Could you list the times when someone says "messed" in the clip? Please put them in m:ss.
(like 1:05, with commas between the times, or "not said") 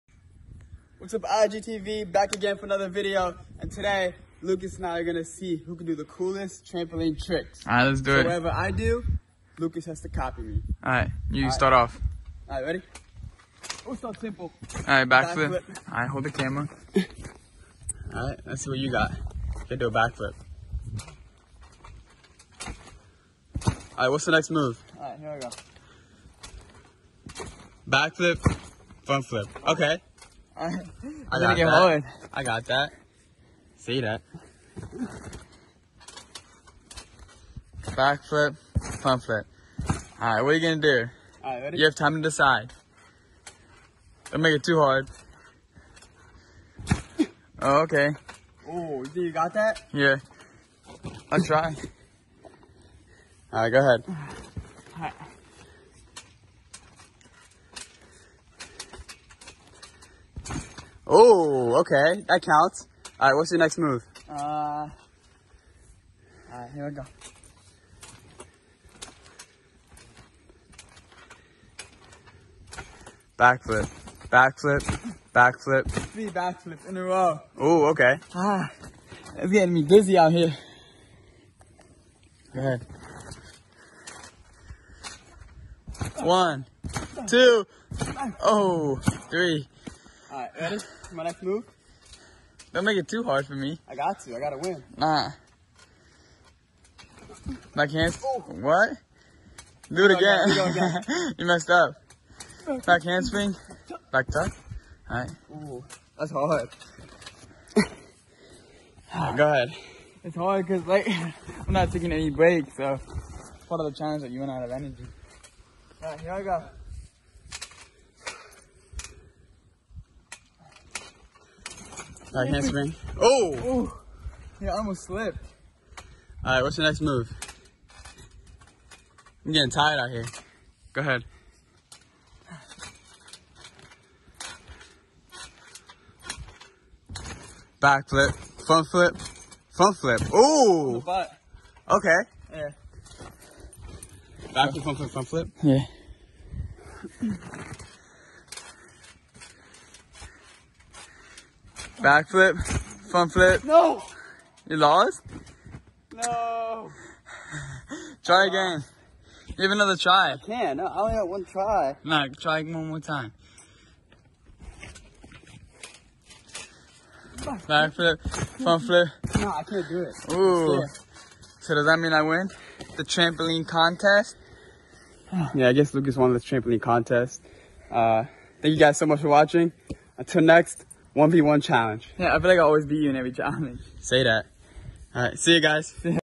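1:41.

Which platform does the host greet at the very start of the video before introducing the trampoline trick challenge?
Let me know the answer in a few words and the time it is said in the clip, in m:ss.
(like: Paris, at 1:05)
IGTV, at 0:01.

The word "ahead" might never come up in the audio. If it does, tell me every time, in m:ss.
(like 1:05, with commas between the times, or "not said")
0:53, 1:22, 1:49, 2:11.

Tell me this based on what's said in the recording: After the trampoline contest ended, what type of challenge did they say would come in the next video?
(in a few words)
1v1 challenge.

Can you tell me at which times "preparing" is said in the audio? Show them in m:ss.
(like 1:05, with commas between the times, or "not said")
not said.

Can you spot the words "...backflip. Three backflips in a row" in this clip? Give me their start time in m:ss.
1:15.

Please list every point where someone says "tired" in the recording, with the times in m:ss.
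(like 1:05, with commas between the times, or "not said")
2:09.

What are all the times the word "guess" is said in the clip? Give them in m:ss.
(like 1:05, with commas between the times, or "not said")
2:55.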